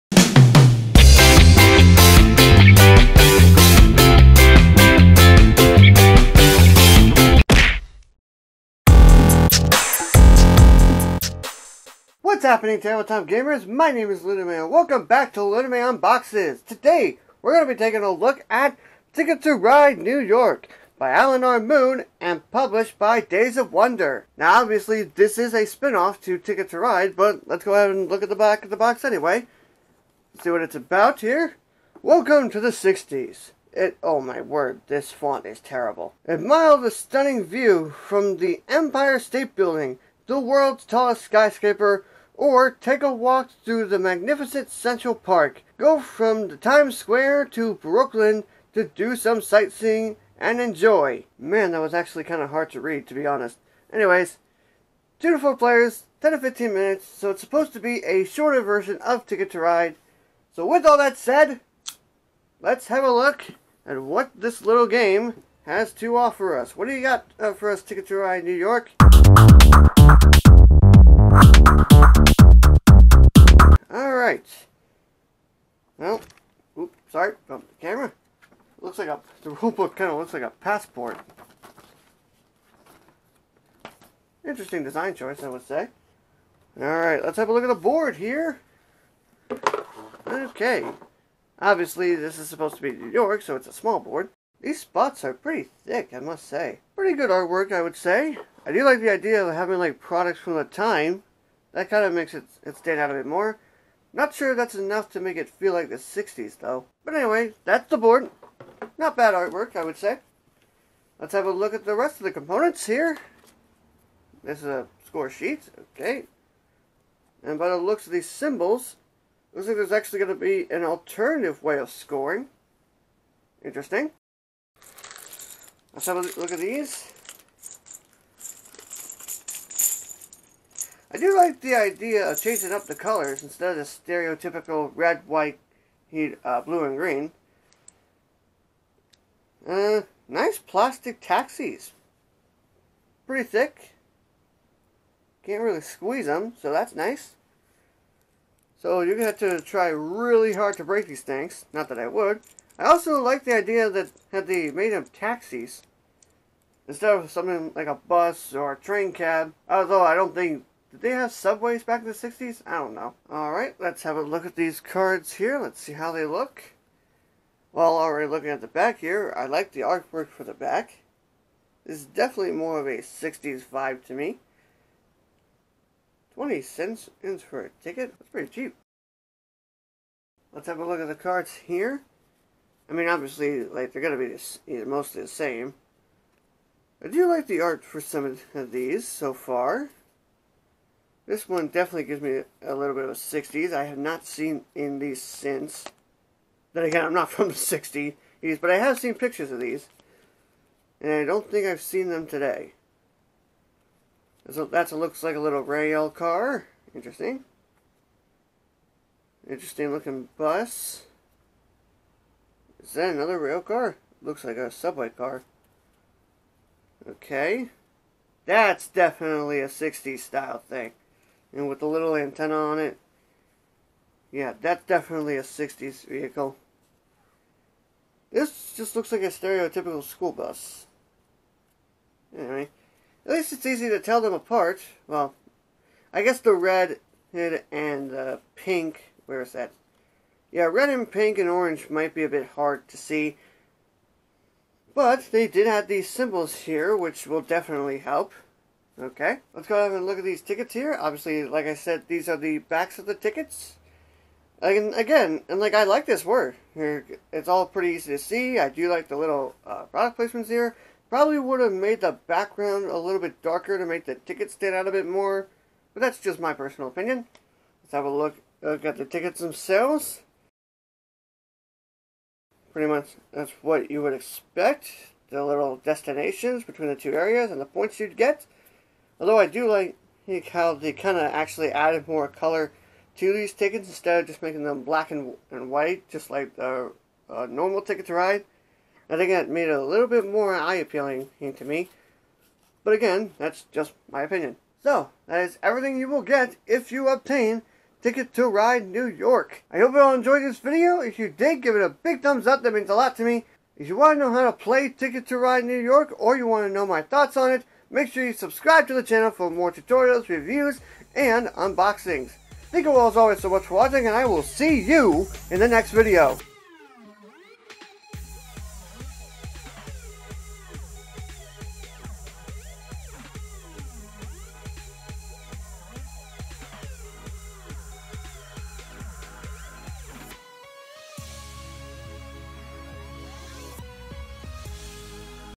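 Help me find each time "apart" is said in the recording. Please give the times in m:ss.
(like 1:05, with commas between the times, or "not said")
3:54.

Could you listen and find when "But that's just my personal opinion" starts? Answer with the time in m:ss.
4:25.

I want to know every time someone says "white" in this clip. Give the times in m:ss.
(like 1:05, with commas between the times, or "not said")
2:15, 4:45.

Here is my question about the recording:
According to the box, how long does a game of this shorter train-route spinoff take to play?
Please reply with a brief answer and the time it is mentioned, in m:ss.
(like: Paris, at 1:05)
10 to 15 minutes, at 0:56.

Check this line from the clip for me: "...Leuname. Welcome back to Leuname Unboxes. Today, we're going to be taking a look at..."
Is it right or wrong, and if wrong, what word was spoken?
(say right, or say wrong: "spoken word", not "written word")
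right.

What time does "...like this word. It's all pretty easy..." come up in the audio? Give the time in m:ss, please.
4:15.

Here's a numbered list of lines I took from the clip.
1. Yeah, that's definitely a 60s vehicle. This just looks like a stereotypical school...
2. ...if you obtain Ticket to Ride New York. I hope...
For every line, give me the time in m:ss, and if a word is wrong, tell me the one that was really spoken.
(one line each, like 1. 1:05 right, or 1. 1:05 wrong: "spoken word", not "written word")
1. 3:44 right
2. 4:56 right.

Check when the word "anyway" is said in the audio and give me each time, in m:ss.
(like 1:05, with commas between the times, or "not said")
0:29, 0:53, 1:47, 3:52.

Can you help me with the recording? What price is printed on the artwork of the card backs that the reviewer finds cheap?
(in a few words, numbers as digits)
20 cents.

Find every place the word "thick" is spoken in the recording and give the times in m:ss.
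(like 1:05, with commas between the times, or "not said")
1:35, 2:23.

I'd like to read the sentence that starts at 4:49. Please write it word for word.
I think that made it a little bit more eye appealing to me.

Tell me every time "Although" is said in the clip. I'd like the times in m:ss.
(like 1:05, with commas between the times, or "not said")
2:39, 4:39.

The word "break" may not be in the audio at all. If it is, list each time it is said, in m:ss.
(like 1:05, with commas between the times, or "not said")
2:30.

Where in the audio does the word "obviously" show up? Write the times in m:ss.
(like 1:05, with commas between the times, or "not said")
0:24, 1:31, 3:03, 4:10.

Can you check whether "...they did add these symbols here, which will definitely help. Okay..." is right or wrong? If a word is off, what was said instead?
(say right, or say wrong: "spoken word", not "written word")
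right.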